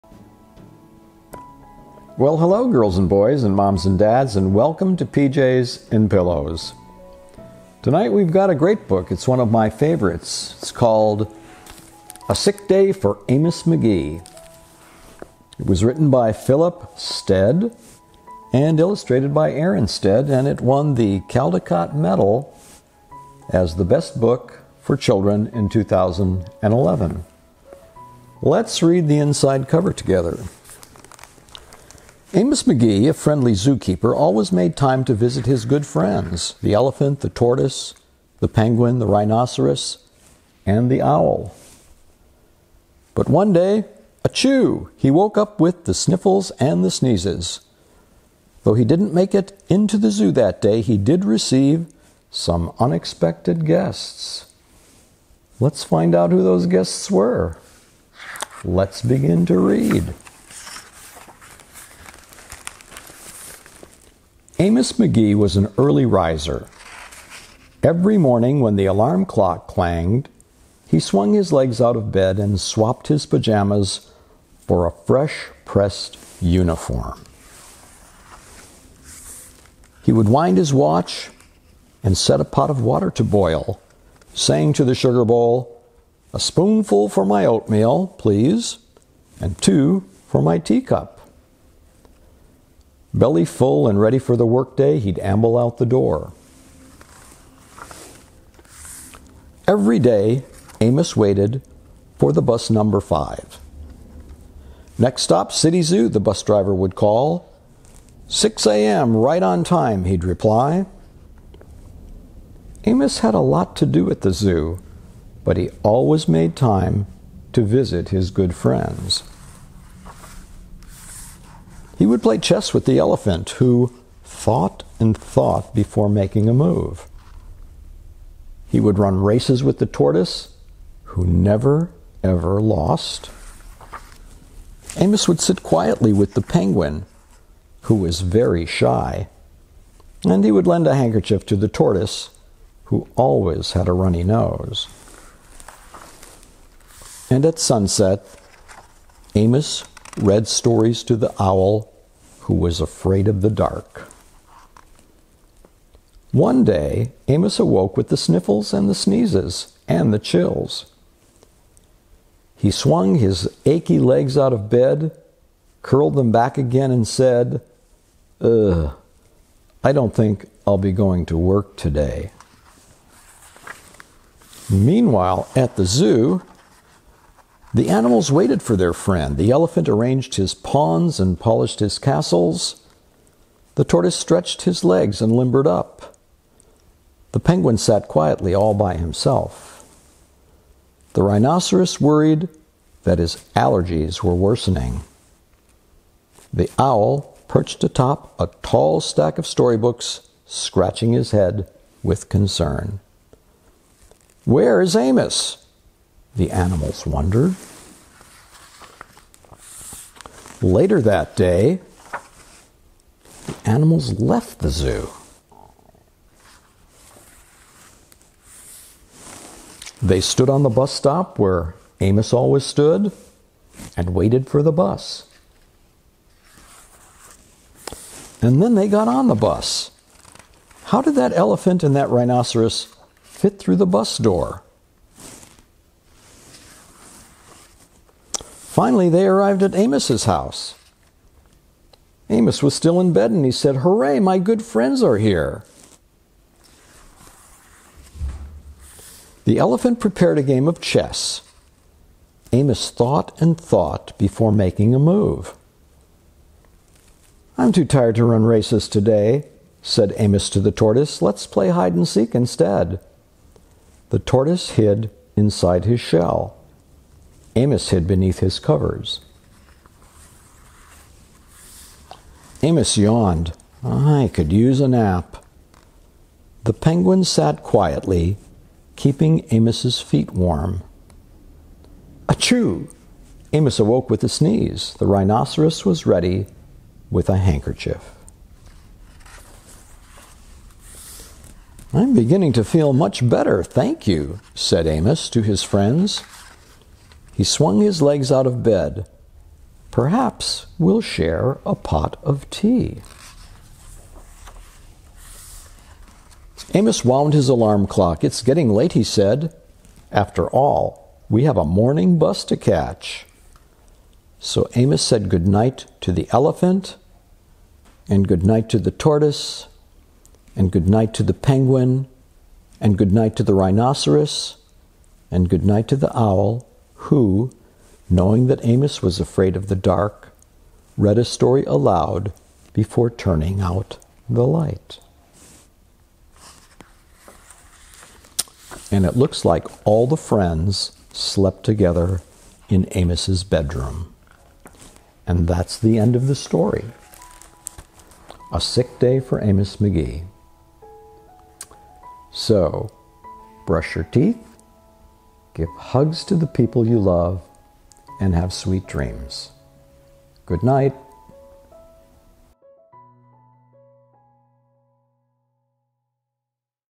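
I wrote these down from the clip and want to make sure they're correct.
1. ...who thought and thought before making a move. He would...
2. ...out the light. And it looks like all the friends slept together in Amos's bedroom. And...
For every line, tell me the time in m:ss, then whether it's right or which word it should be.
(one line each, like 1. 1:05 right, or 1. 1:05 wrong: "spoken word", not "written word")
1. 2:03 right
2. 5:33 right.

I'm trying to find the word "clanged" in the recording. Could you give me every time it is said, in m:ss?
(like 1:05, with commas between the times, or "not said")
1:09.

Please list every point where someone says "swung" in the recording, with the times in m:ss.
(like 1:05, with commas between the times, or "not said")
1:10, 2:42, 4:57.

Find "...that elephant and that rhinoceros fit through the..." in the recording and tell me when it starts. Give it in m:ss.
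3:51.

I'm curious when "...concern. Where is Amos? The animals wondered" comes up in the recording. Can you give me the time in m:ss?
3:22.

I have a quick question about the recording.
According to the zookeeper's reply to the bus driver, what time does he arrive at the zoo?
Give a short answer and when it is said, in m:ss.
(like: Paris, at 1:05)
6 a.m., at 1:48.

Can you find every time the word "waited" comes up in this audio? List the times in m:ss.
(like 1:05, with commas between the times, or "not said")
1:41, 2:58, 3:44.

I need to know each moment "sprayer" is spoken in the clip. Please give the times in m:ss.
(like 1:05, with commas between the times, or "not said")
not said.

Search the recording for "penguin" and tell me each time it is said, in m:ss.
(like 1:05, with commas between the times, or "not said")
0:38, 2:16, 3:07, 4:36, 5:21.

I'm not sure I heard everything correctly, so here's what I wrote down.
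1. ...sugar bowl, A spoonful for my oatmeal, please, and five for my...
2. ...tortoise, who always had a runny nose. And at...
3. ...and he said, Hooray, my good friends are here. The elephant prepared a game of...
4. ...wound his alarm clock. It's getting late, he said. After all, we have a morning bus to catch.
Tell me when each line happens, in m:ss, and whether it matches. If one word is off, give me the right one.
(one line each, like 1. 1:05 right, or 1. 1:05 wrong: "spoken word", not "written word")
1. 1:24 wrong: "two", not "five"
2. 2:21 right
3. 4:03 right
4. 5:07 right.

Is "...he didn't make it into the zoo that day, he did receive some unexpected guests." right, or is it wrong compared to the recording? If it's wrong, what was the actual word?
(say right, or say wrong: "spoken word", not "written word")
right.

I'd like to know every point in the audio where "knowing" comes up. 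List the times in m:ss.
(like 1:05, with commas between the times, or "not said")
5:28.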